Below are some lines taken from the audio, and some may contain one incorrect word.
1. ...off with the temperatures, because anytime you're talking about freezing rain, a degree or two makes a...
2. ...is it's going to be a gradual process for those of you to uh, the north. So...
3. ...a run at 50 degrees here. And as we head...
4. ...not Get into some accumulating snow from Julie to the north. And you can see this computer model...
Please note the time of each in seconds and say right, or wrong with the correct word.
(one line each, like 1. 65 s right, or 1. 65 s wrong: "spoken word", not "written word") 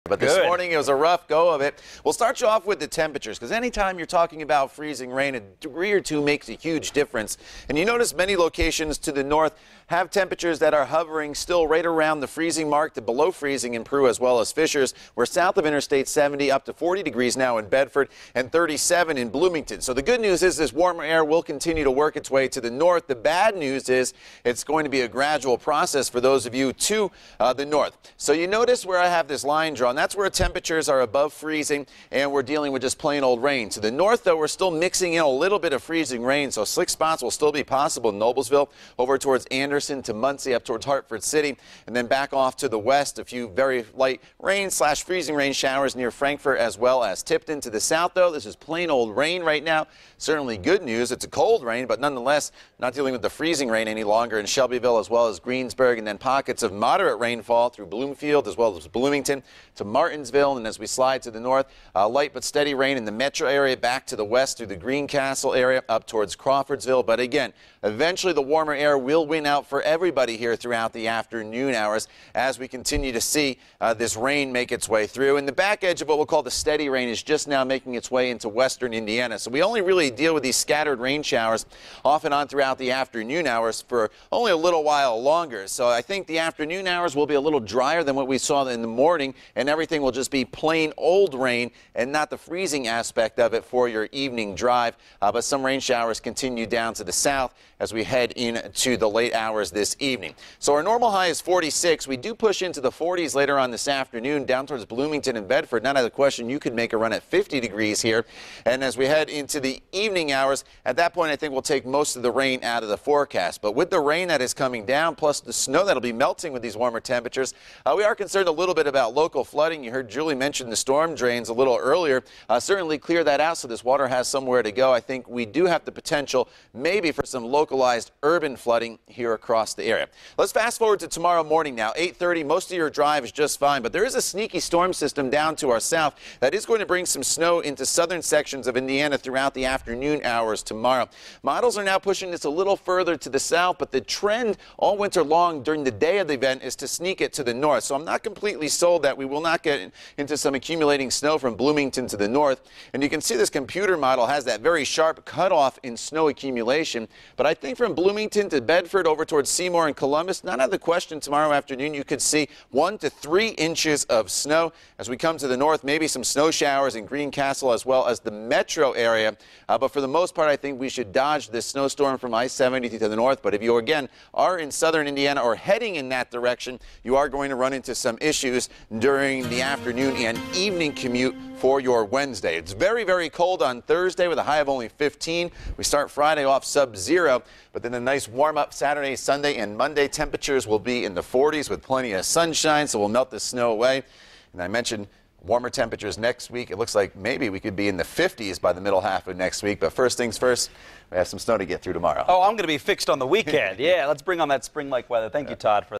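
1. 2 s right
2. 23 s right
3. 106 s right
4. 149 s wrong: "Bloomington", not "Julie".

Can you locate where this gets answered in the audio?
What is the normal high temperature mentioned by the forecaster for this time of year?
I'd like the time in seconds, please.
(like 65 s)
101 s.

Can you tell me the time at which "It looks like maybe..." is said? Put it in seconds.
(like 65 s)
196 s.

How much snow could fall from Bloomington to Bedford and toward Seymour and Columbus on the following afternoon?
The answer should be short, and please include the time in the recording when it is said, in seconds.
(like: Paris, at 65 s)
1 to 3 inches, at 162 s.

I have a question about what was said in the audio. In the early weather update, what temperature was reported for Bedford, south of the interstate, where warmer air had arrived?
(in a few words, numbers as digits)
40 degrees.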